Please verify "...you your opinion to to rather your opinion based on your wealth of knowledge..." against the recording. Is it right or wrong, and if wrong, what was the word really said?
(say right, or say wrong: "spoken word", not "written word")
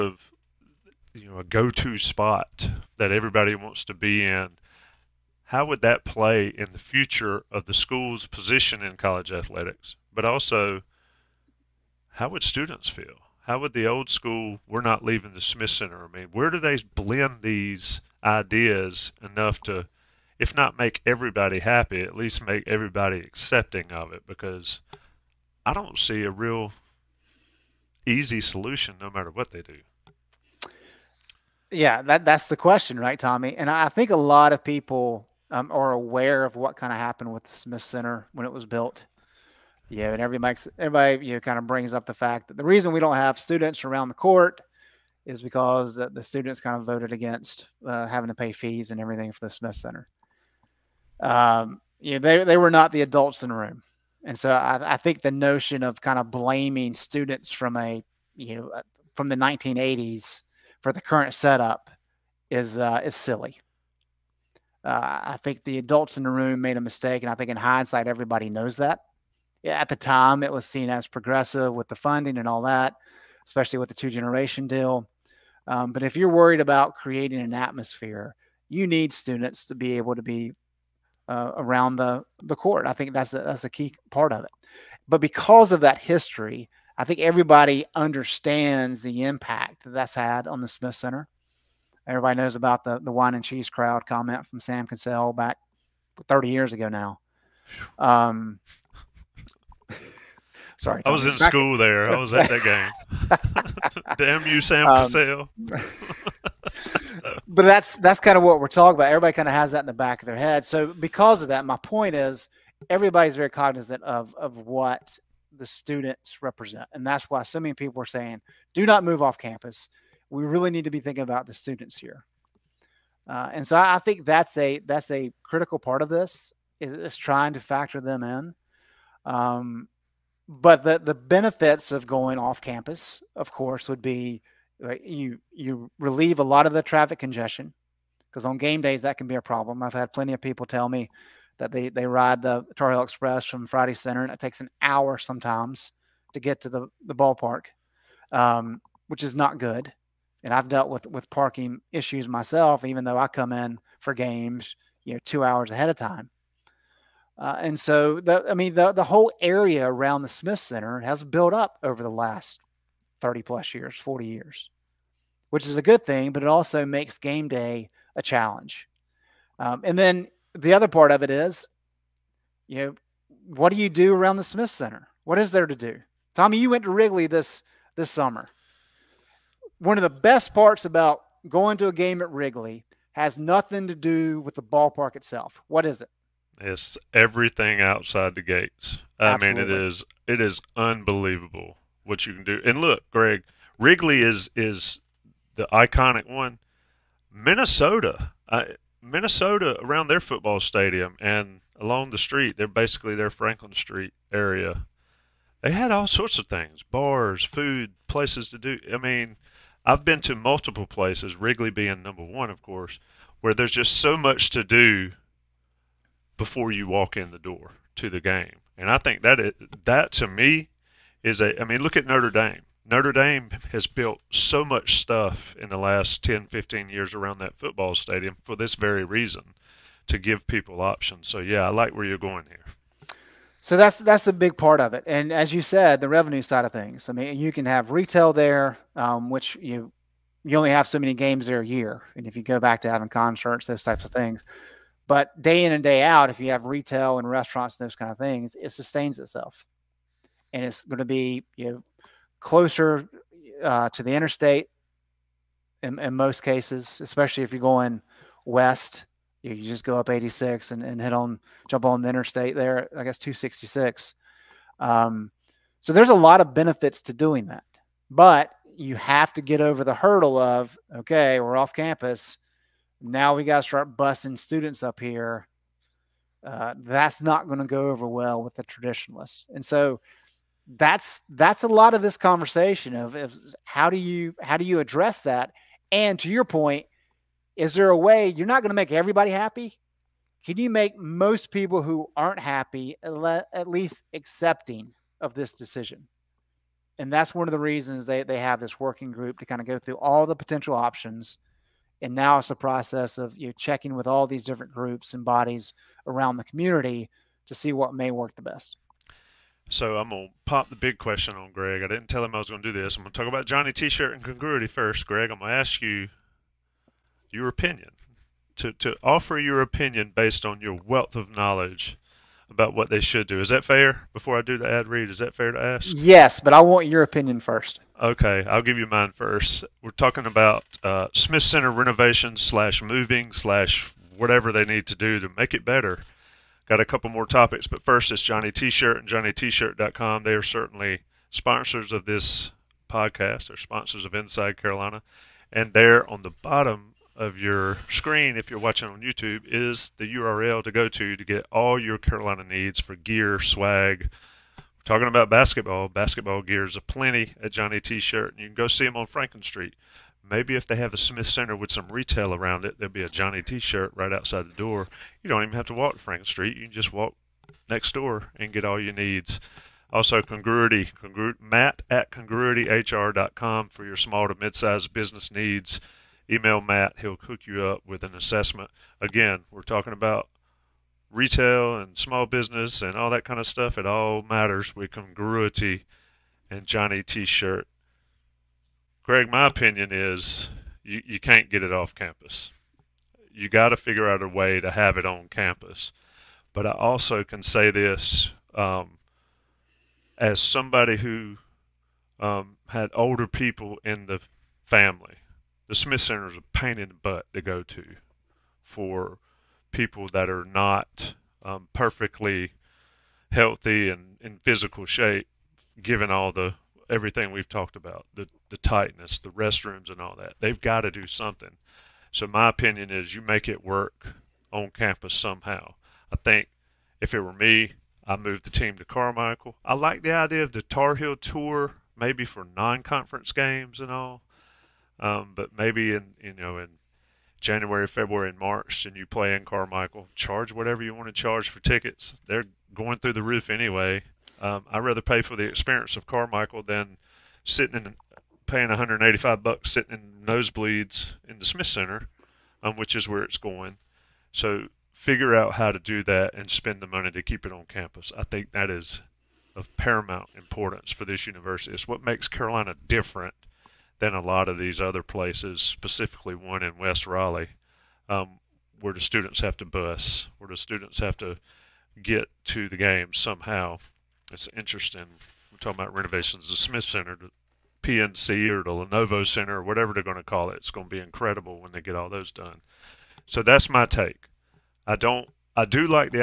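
wrong: "offer", not "rather".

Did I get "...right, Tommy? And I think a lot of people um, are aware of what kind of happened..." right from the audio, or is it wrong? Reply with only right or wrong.
right.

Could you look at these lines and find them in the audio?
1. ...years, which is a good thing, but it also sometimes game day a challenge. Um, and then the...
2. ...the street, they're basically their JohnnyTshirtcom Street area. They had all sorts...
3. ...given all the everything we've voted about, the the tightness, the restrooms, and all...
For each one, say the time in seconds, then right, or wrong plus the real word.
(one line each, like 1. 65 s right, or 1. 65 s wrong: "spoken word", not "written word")
1. 164 s wrong: "makes", not "sometimes"
2. 202 s wrong: "Franklin", not "JohnnyTshirtcom"
3. 415 s wrong: "talked", not "voted".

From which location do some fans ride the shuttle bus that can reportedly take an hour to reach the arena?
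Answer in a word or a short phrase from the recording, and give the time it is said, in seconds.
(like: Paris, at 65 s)
Friday Center, at 143 s.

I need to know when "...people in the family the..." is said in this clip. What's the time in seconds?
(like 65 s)
403 s.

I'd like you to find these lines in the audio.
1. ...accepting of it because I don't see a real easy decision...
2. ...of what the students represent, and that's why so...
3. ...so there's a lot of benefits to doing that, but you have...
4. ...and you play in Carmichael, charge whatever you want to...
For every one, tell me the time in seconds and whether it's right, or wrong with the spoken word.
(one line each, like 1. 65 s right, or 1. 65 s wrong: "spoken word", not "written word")
1. 23 s wrong: "solution", not "decision"
2. 114 s right
3. 265 s right
4. 438 s right.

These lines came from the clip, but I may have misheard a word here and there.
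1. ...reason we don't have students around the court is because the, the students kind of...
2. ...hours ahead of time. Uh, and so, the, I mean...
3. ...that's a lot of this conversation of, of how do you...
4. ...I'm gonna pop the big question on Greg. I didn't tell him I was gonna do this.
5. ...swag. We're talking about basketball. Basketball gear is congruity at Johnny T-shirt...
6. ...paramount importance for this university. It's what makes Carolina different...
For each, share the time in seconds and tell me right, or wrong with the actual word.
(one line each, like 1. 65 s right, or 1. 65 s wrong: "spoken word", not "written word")
1. 42 s right
2. 155 s right
3. 281 s right
4. 309 s right
5. 353 s wrong: "plenty", not "congruity"
6. 459 s right.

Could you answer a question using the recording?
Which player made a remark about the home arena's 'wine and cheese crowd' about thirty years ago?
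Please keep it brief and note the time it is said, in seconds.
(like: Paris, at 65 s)
Sam Cassell, at 94 s.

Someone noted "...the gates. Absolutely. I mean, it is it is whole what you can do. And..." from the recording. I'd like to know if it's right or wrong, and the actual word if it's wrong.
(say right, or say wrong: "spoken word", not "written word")
wrong: "unbelievable", not "whole".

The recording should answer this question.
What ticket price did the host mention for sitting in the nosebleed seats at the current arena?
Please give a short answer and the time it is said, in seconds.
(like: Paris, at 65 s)
$185, at 448 s.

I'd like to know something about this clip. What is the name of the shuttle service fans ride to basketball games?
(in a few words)
Tar Heel Express.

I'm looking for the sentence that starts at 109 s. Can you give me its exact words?
Everybody kind of has that in the back of their head.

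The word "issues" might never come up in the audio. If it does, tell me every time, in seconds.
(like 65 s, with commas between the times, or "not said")
151 s.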